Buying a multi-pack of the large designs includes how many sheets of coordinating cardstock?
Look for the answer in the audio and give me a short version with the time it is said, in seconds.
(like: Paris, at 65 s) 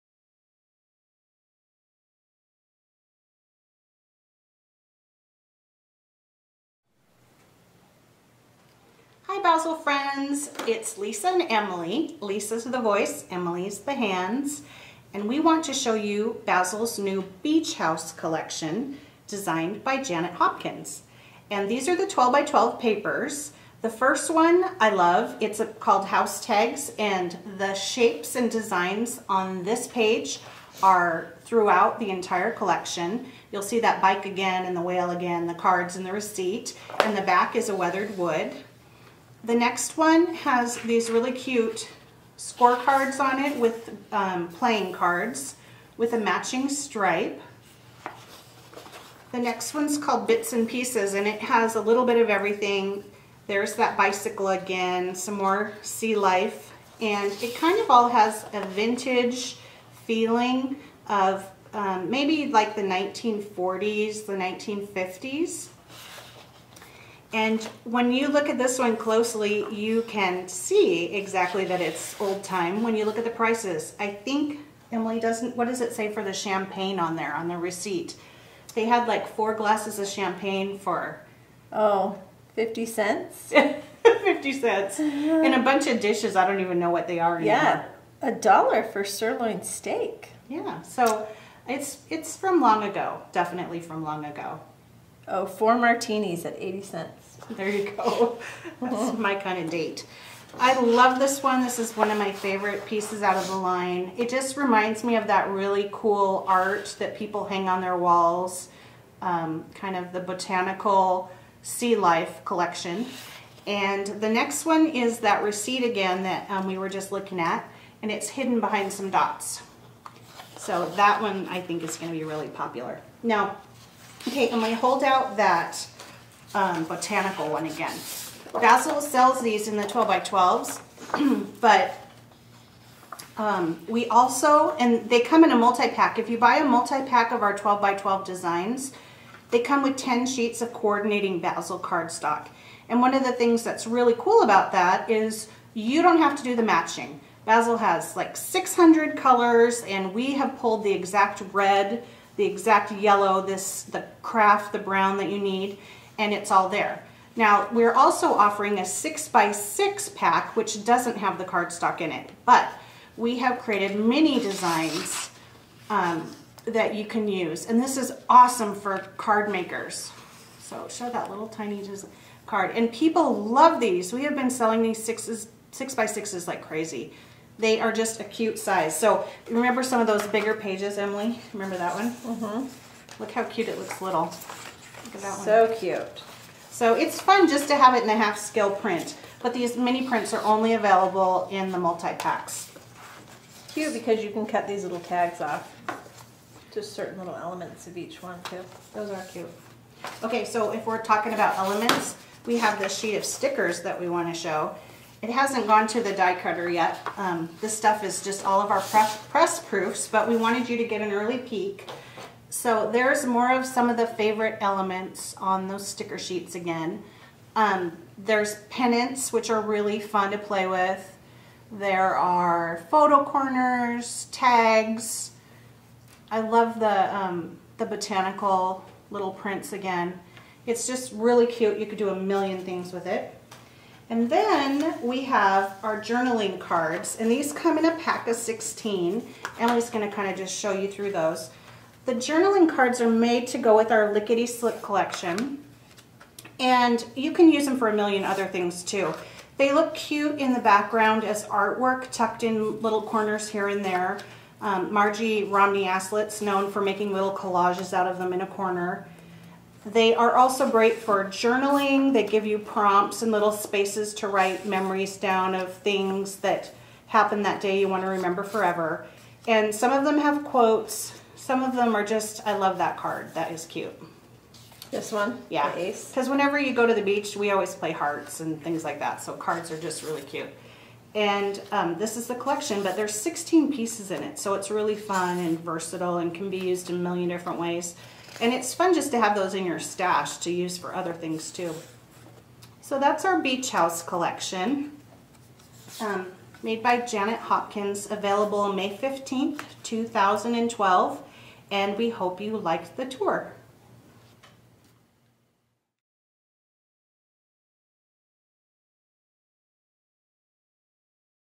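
10, at 139 s.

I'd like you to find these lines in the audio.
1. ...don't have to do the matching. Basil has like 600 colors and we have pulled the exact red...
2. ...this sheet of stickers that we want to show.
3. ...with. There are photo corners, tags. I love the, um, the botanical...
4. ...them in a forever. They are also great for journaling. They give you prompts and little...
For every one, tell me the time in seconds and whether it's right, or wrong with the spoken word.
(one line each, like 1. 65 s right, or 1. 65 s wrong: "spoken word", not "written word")
1. 146 s right
2. 202 s right
3. 220 s right
4. 258 s wrong: "corner", not "forever".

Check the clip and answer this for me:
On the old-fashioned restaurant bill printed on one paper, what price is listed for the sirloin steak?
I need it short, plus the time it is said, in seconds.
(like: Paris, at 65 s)
a dollar, at 88 s.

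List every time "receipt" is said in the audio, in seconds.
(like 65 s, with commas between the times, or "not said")
36 s, 77 s, 115 s.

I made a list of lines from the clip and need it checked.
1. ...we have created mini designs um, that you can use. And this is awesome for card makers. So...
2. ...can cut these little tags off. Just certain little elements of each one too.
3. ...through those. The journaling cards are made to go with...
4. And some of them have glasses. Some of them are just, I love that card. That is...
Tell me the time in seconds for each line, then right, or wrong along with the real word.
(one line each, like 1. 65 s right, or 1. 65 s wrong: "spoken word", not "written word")
1. 163 s right
2. 194 s right
3. 240 s right
4. 269 s wrong: "quotes", not "glasses".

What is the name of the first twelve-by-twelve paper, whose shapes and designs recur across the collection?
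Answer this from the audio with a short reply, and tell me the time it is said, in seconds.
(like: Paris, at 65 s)
House Tags, at 26 s.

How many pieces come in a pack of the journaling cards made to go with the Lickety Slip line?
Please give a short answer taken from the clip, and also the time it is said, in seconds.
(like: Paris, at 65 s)
16, at 237 s.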